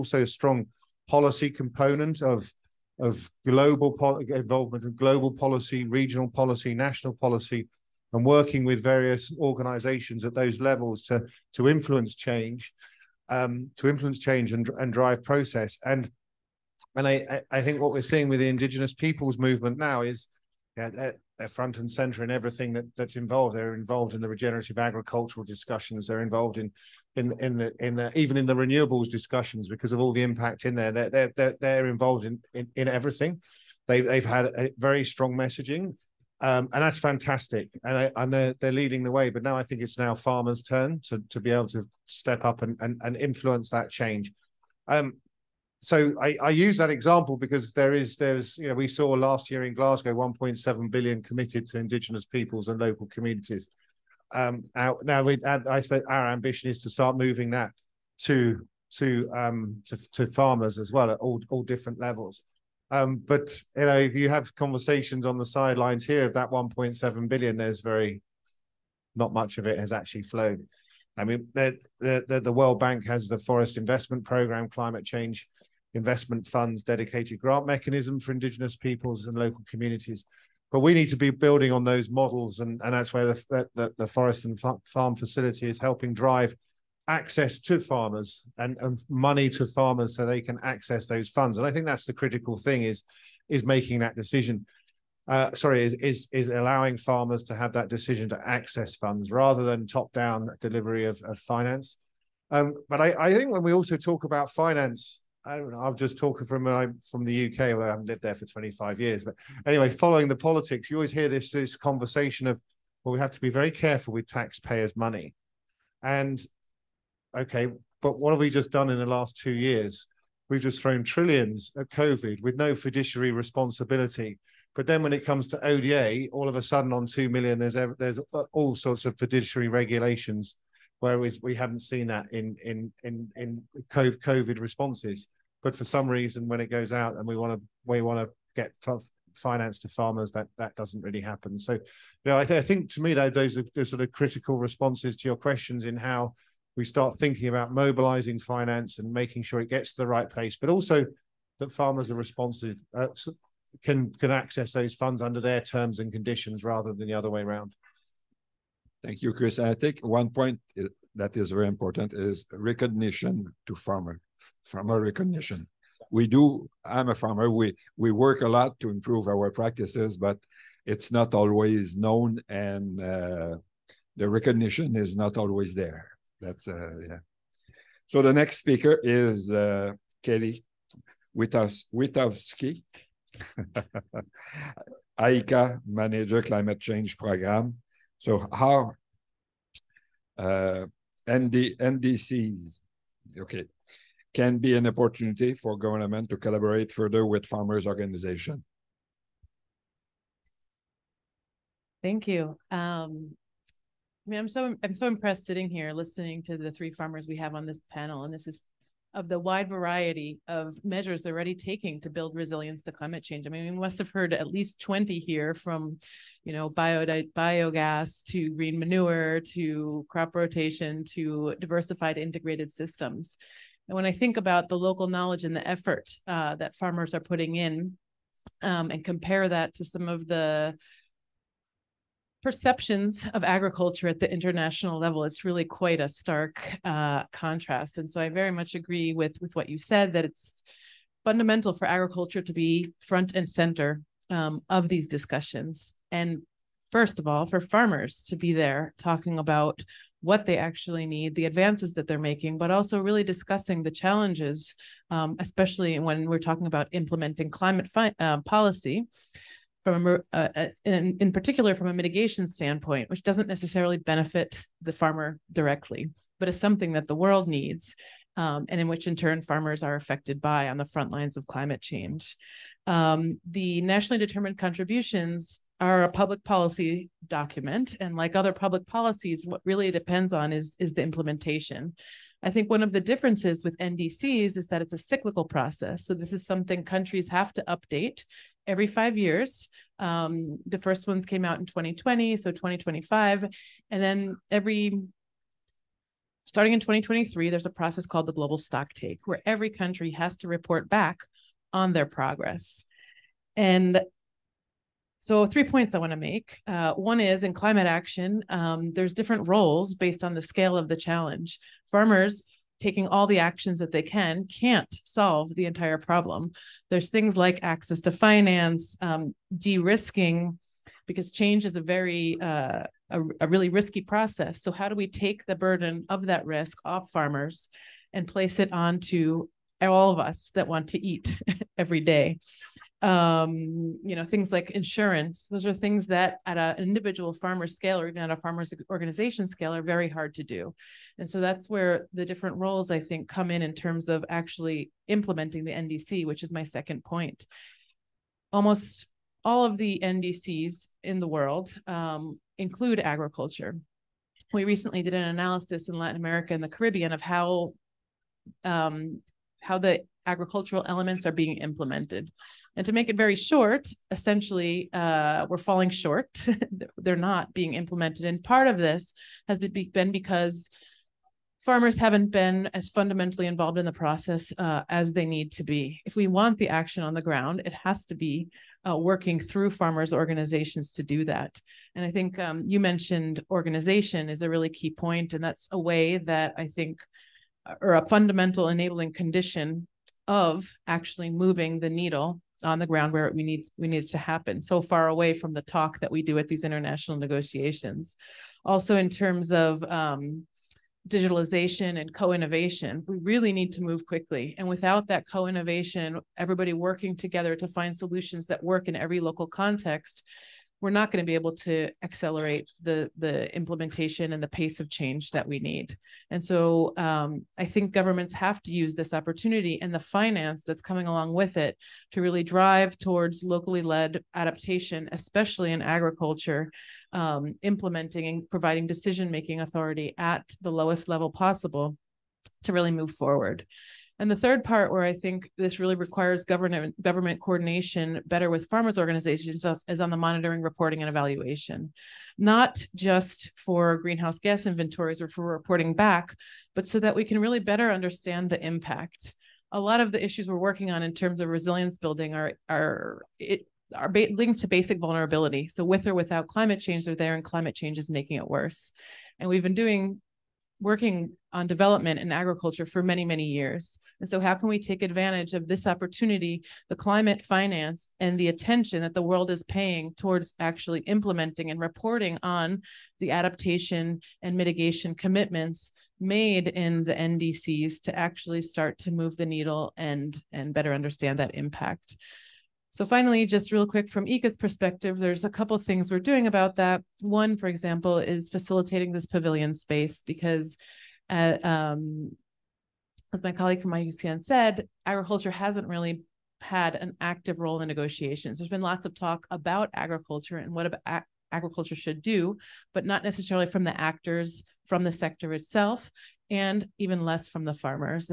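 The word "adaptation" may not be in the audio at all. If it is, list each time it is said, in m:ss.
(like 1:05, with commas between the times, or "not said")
7:04, 7:53.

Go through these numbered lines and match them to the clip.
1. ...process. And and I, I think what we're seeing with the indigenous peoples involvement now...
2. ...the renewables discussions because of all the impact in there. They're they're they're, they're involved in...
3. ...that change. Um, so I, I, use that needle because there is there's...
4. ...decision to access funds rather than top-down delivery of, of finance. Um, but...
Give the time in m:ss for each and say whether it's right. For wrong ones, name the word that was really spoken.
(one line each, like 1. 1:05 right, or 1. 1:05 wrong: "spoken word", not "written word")
1. 0:15 wrong: "movement", not "involvement"
2. 0:28 right
3. 0:43 wrong: "example", not "needle"
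4. 1:37 right.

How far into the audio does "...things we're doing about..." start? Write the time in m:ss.
8:05.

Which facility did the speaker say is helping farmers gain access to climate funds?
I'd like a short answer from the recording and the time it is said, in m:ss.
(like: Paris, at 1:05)
forest and farm facility, at 1:24.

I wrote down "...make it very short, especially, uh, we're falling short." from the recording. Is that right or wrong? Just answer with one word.
wrong.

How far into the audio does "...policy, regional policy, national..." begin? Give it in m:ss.
0:05.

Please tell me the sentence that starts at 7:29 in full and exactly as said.
A lot of the issues we're working on in terms of resilience building are are it, are linked to basic vulnerability.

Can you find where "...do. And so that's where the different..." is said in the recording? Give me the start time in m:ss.
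5:40.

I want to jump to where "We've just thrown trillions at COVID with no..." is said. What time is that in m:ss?
2:00.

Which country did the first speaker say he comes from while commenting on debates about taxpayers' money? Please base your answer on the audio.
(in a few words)
UK.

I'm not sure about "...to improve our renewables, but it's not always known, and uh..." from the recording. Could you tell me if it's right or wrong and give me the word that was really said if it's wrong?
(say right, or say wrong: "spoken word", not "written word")
wrong: "practices", not "renewables".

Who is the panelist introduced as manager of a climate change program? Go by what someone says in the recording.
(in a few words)
Kelly Witkowski.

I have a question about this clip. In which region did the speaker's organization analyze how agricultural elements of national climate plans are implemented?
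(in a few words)
Latin America and the Caribbean.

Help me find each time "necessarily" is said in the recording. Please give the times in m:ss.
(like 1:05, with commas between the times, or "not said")
4:23, 8:23.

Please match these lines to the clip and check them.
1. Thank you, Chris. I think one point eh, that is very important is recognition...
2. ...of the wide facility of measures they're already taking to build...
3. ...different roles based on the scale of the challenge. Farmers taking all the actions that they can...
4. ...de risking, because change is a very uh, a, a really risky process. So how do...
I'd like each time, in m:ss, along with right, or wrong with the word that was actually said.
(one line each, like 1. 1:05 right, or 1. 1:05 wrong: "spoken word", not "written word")
1. 2:39 right
2. 3:29 wrong: "variety", not "facility"
3. 5:09 right
4. 5:19 right.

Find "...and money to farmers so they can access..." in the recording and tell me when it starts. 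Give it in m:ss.
1:28.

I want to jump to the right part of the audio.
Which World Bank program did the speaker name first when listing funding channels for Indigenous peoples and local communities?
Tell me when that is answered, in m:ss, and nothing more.
1:13.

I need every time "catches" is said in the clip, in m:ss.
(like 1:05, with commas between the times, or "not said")
not said.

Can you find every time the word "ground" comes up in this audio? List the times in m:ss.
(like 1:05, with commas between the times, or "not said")
6:17, 6:32.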